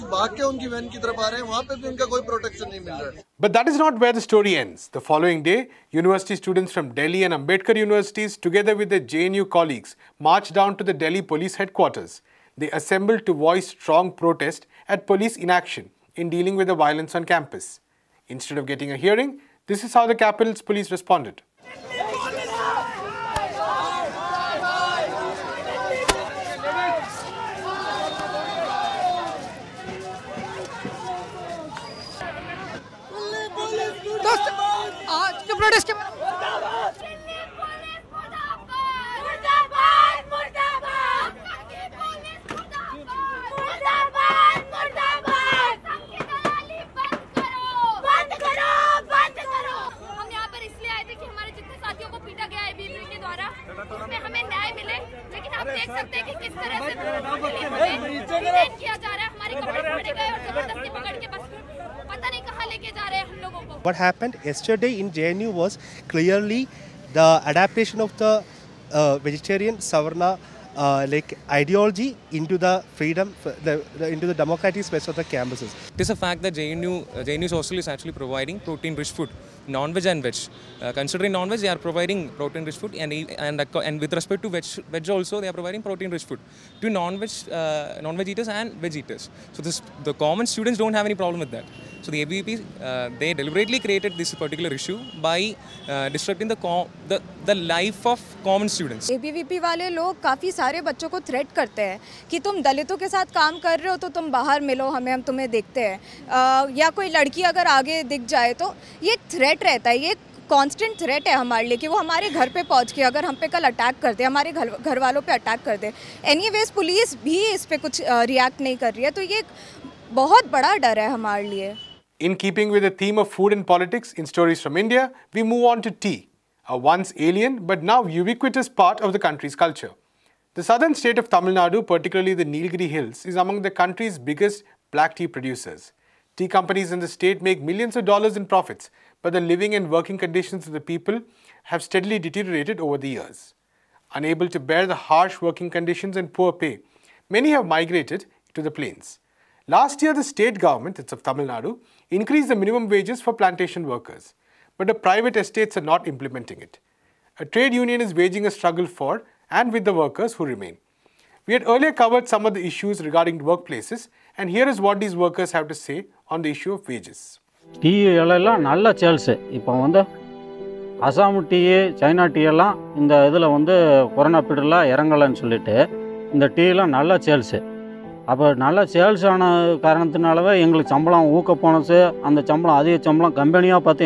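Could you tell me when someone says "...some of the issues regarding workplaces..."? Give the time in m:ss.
2:42.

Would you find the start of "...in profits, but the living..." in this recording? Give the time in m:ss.
2:18.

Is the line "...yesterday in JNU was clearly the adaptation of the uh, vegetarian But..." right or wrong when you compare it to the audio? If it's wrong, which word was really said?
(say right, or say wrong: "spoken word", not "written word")
wrong: "Savarna", not "But".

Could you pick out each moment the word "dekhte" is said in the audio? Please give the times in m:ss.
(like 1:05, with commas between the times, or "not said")
1:45.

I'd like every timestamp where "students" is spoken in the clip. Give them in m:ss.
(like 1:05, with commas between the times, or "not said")
0:06, 1:30, 1:38.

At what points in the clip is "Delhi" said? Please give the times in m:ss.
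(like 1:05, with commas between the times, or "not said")
0:06, 0:11.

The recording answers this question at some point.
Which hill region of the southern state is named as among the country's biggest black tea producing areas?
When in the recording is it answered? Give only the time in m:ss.
2:12.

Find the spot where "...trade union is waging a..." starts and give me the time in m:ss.
2:37.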